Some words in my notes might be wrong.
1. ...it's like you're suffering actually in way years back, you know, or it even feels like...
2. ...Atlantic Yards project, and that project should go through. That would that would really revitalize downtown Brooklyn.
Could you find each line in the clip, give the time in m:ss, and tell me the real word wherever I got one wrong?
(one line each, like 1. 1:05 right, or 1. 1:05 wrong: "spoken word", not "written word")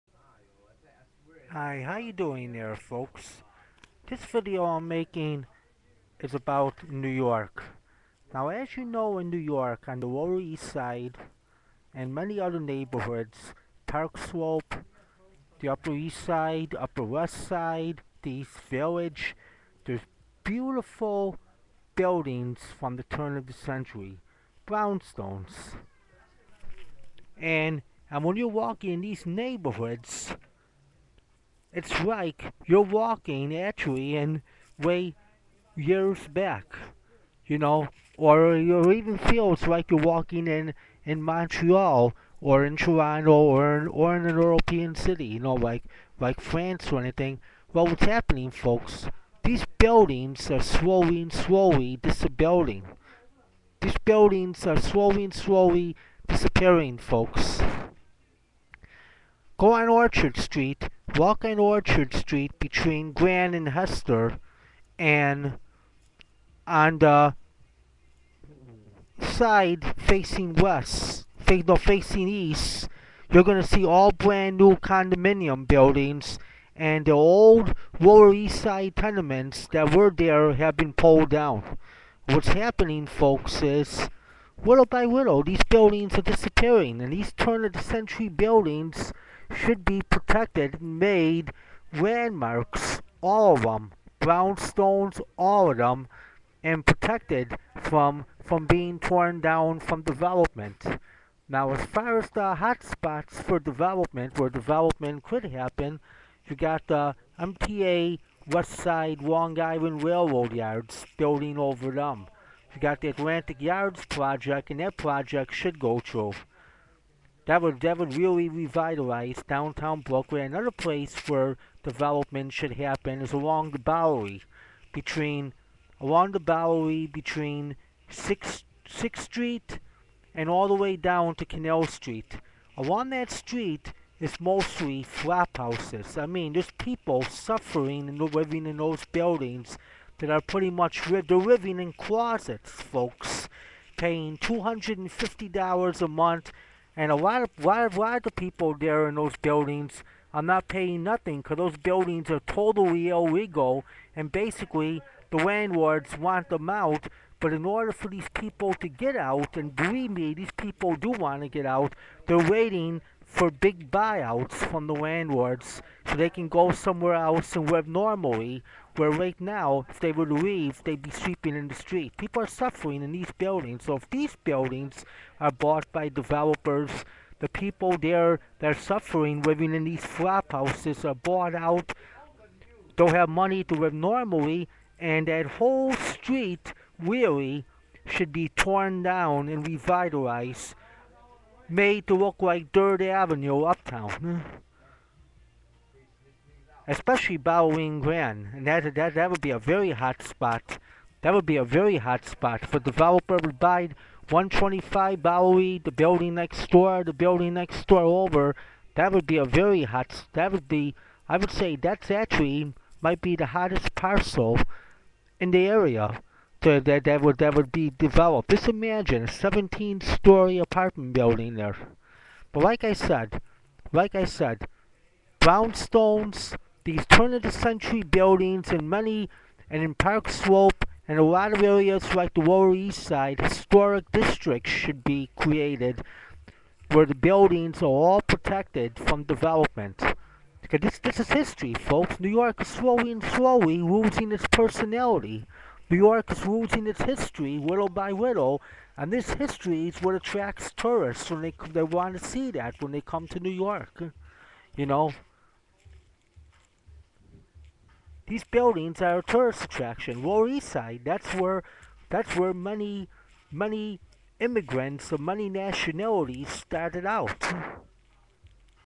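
1. 0:31 wrong: "walking", not "suffering"
2. 1:53 right.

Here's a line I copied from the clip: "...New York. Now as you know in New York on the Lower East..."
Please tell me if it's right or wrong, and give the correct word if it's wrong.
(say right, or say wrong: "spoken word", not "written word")
right.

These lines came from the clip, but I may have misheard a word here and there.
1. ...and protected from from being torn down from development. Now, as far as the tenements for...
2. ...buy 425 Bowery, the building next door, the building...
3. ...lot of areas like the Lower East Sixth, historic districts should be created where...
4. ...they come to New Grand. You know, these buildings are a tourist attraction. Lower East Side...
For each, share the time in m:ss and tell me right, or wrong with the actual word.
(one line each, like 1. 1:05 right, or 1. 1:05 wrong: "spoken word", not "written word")
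1. 1:36 wrong: "hotspots", not "tenements"
2. 3:23 wrong: "125", not "425"
3. 3:51 wrong: "Side", not "Sixth"
4. 4:12 wrong: "York", not "Grand".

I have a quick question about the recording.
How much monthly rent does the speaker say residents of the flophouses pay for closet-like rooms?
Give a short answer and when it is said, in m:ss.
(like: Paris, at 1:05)
$250, at 2:24.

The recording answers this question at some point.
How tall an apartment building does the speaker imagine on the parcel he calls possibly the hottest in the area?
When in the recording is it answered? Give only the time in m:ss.
3:39.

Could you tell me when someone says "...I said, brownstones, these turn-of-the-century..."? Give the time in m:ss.
3:44.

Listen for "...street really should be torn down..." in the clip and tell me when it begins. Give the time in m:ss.
3:05.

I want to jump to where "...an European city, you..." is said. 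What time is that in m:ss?
0:44.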